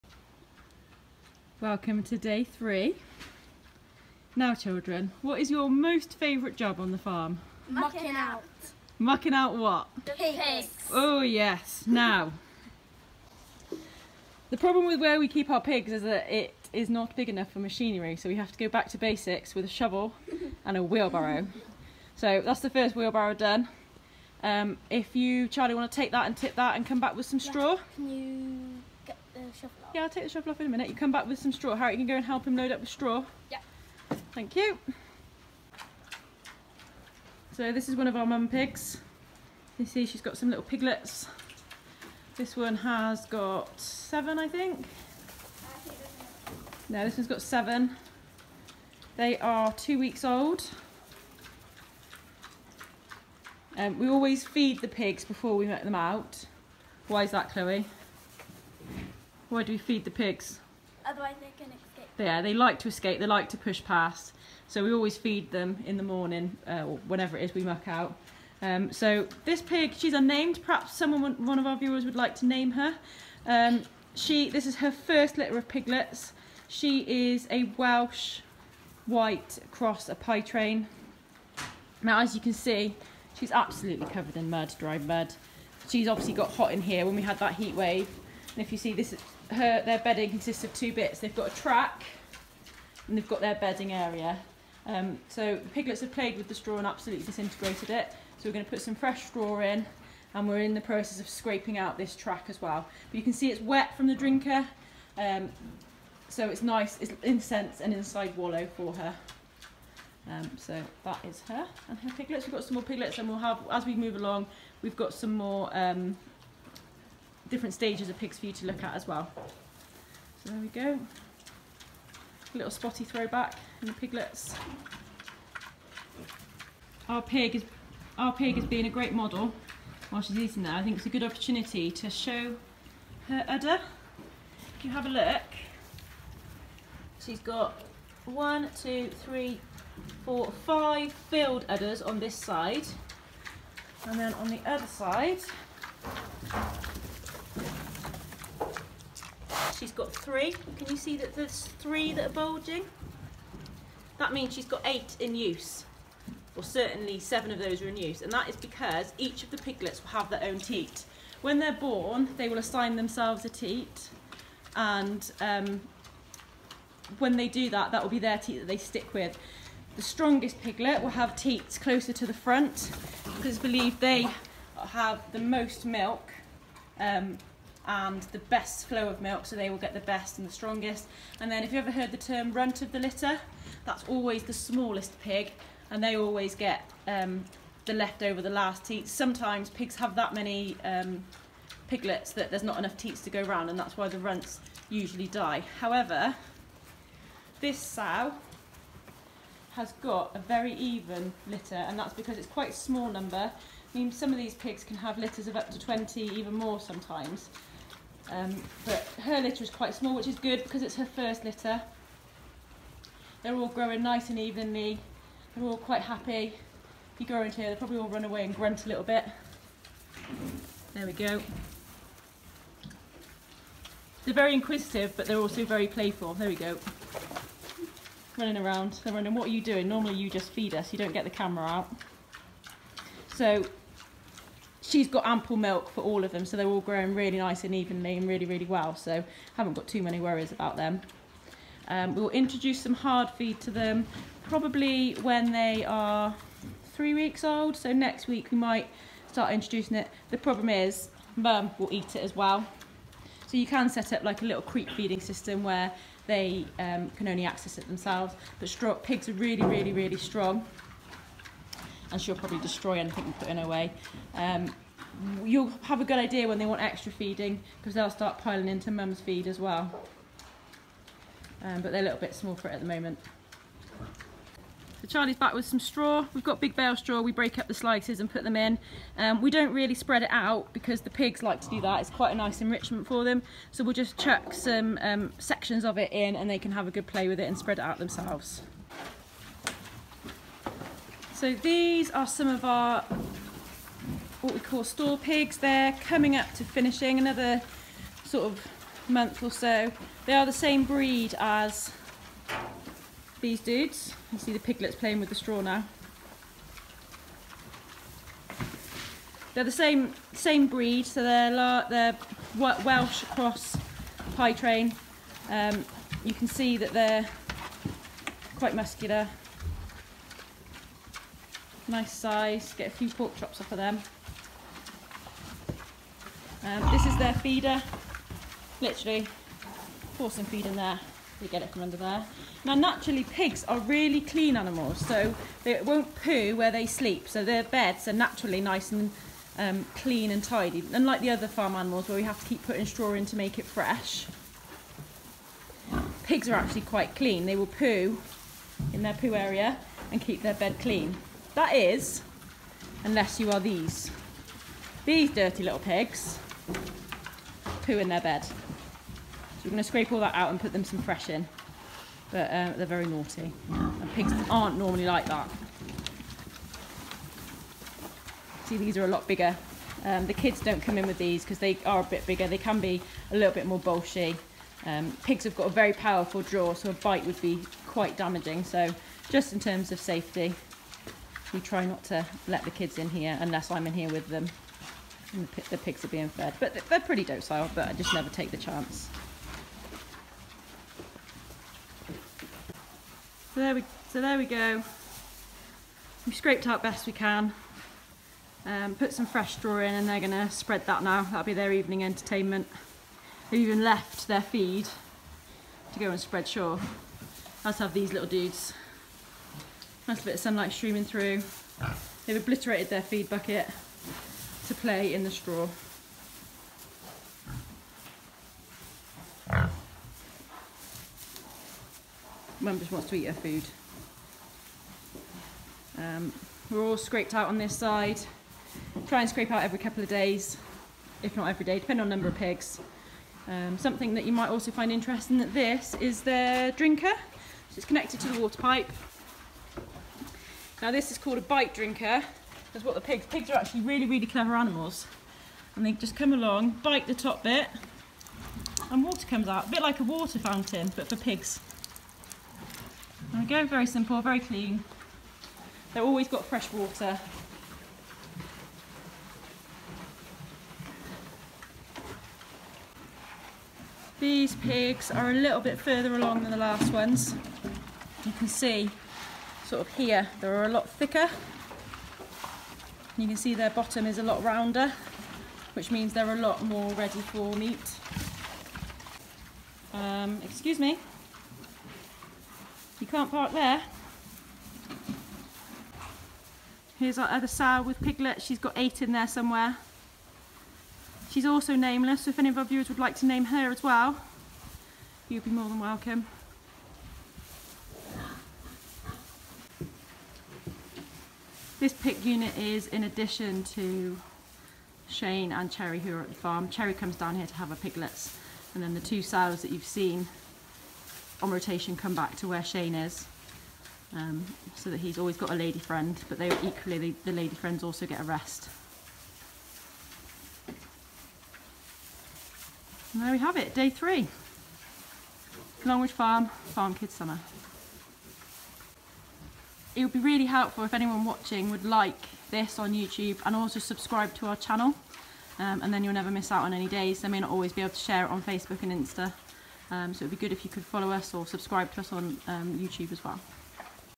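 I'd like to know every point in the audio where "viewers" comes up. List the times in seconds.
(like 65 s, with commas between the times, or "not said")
71 s, 492 s.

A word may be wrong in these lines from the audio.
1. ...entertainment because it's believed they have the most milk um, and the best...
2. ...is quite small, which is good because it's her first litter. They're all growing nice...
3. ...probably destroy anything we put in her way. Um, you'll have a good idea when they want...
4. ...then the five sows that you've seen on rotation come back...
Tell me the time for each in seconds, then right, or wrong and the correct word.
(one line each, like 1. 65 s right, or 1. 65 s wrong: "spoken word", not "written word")
1. 172 s wrong: "front", not "entertainment"
2. 209 s right
3. 262 s right
4. 508 s wrong: "two", not "five".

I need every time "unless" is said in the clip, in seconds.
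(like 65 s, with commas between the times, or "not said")
353 s, 383 s.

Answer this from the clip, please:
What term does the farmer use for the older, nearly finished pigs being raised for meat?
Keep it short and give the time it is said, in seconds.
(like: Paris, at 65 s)
store pigs, at 294 s.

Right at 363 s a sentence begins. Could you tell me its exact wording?
And pigs aren't normally like that.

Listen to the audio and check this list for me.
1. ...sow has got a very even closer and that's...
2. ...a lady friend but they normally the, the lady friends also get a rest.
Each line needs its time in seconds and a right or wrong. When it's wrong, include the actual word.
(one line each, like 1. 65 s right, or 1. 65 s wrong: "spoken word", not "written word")
1. 197 s wrong: "litter", not "closer"
2. 515 s wrong: "equally", not "normally".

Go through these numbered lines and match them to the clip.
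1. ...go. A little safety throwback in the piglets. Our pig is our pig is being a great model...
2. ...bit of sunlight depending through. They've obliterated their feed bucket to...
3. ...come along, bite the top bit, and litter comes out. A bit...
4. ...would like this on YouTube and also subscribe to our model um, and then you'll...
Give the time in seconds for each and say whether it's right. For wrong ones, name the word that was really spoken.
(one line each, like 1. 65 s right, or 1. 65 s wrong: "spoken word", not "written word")
1. 120 s wrong: "spotty", not "safety"
2. 410 s wrong: "streaming", not "depending"
3. 446 s wrong: "water", not "litter"
4. 531 s wrong: "channel", not "model".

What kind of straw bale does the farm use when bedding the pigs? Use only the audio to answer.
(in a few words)
big bale.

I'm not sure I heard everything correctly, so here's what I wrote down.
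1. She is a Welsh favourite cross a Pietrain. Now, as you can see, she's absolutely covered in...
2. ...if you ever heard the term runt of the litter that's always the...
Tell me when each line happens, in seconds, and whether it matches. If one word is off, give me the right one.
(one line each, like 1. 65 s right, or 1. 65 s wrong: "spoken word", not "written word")
1. 76 s wrong: "white", not "favourite"
2. 181 s right.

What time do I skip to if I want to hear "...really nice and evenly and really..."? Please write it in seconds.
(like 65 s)
237 s.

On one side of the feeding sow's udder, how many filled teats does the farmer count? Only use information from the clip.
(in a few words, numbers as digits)
5.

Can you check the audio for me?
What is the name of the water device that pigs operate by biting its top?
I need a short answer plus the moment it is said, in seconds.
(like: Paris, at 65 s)
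bite drinker, at 441 s.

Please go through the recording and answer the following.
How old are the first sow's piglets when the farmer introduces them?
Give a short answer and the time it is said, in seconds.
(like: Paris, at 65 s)
2 weeks, at 49 s.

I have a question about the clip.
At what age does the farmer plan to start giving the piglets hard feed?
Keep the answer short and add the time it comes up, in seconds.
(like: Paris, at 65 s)
3 weeks, at 246 s.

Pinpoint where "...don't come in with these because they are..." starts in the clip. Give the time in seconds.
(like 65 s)
370 s.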